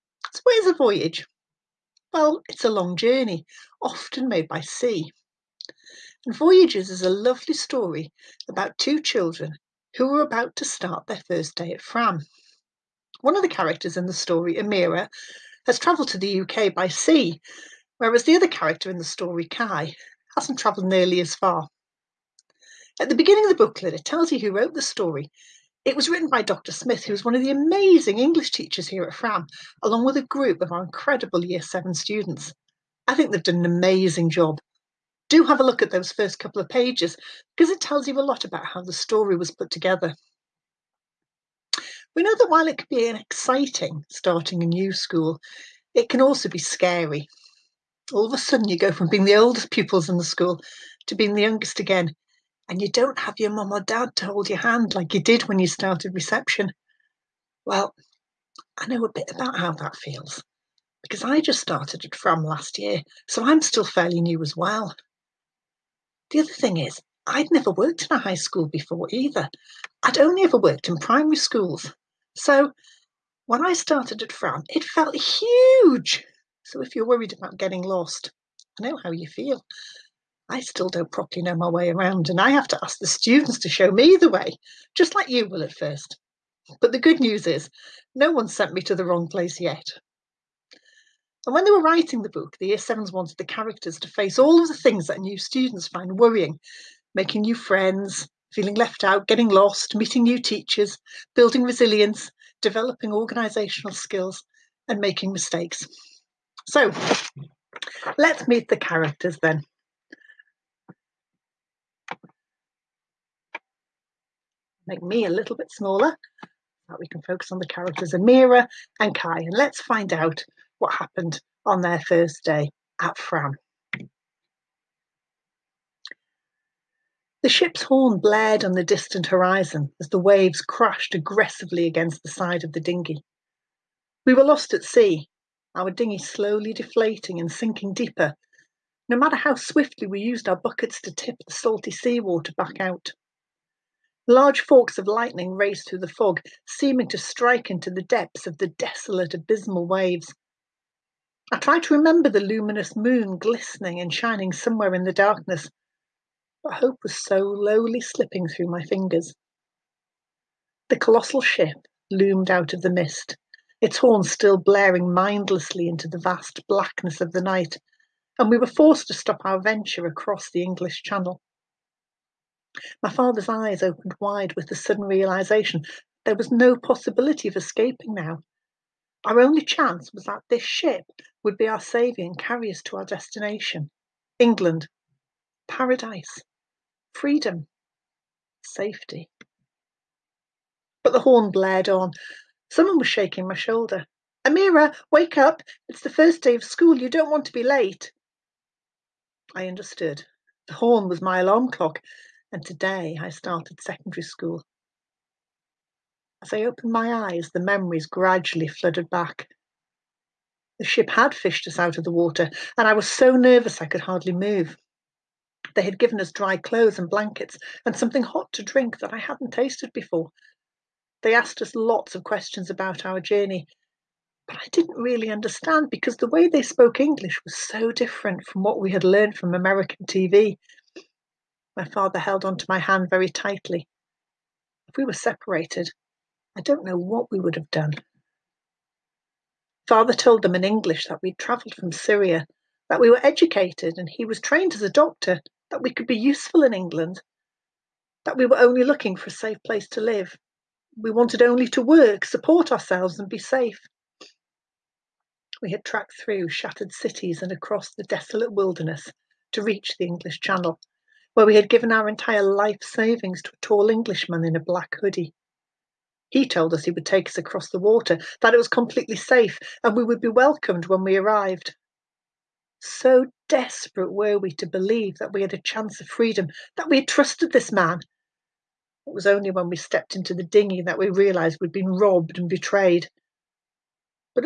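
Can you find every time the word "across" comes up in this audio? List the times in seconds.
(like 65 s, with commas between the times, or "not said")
170 s, 257 s, 267 s.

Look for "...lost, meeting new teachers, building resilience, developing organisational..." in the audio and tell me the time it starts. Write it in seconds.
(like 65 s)
99 s.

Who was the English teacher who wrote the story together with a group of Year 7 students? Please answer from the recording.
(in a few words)
Dr. Smith.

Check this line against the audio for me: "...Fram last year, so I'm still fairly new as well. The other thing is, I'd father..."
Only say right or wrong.
wrong.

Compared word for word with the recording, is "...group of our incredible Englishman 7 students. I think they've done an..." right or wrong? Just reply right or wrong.
wrong.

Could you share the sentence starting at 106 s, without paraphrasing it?
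So let's meet the characters then.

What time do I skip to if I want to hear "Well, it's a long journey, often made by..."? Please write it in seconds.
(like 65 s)
2 s.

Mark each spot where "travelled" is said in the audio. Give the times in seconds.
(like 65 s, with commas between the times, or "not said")
15 s, 20 s, 241 s.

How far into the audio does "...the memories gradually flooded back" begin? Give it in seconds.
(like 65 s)
207 s.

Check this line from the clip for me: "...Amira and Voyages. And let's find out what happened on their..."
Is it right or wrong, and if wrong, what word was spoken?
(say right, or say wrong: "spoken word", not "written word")
wrong: "Kai", not "Voyages".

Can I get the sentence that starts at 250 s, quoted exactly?
We wanted only to work, support ourselves, and be safe.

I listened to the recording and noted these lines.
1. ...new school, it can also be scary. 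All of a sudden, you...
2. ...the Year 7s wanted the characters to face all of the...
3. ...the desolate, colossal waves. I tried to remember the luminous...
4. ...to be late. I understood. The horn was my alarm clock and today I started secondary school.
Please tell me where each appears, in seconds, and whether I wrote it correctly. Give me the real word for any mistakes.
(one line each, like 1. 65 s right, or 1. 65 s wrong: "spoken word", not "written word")
1. 44 s right
2. 92 s right
3. 148 s wrong: "abysmal", not "colossal"
4. 197 s right.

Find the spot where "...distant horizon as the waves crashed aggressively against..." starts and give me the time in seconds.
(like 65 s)
128 s.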